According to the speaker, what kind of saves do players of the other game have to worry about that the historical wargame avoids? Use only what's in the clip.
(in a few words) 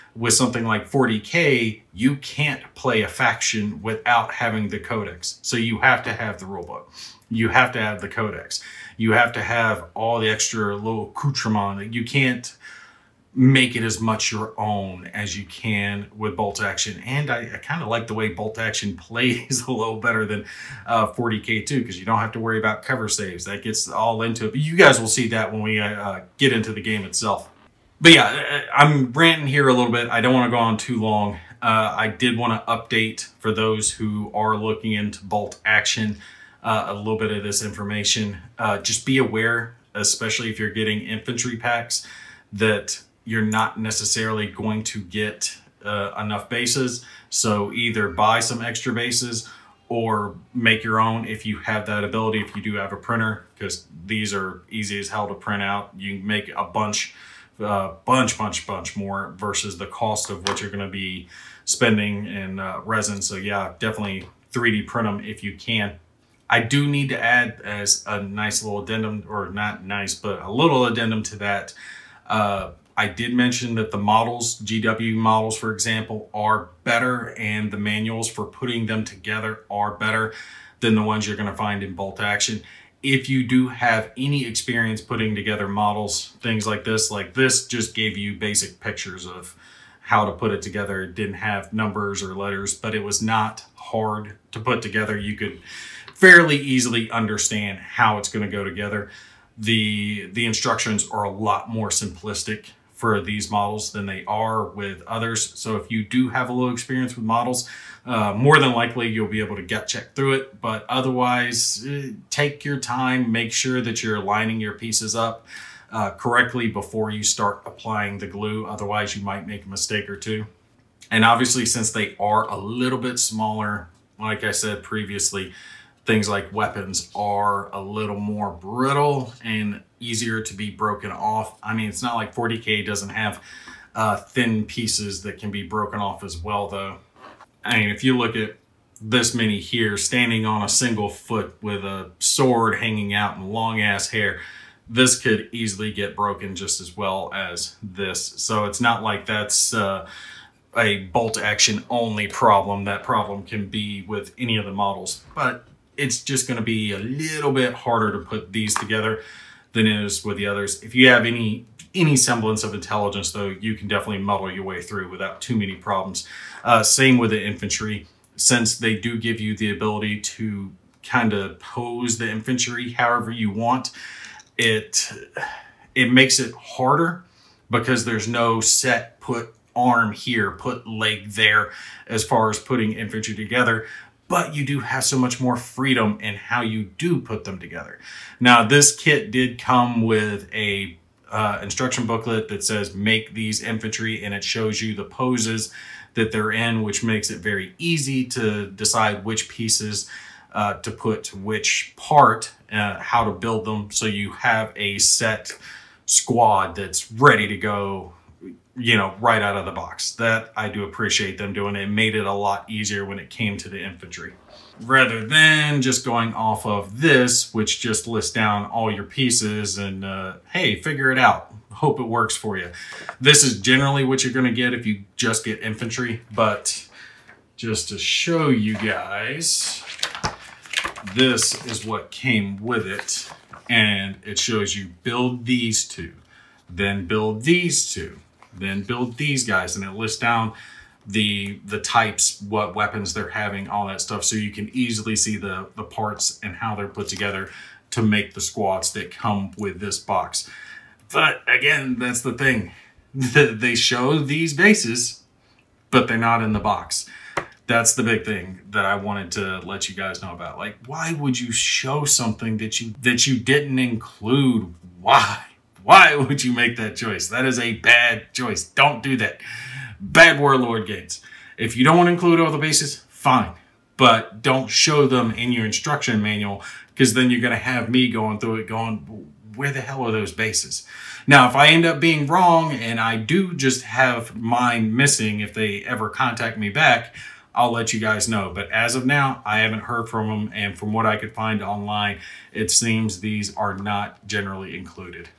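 Cover saves.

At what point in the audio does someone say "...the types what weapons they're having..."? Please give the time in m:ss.
4:01.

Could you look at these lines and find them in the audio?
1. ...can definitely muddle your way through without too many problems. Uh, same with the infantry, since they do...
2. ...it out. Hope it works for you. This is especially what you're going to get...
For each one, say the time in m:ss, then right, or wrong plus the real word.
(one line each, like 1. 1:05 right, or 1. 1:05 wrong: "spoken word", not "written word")
1. 2:43 right
2. 3:41 wrong: "generally", not "especially".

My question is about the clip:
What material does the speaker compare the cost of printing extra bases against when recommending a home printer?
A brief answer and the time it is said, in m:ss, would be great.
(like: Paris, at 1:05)
Resin, at 1:02.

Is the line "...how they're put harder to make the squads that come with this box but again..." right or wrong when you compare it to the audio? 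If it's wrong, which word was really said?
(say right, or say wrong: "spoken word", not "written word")
wrong: "together", not "harder".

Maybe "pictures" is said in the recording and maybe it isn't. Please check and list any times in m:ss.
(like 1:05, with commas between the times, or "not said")
1:28.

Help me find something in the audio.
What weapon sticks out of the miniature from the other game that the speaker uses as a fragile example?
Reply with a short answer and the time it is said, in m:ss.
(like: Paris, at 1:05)
Sword, at 2:22.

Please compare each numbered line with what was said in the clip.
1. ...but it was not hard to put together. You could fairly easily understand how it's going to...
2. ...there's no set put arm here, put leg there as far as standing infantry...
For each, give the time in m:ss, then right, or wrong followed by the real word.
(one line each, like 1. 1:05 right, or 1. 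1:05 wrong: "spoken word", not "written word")
1. 1:32 right
2. 2:58 wrong: "putting", not "standing".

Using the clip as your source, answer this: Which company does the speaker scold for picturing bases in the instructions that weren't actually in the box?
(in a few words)
Warlord Games.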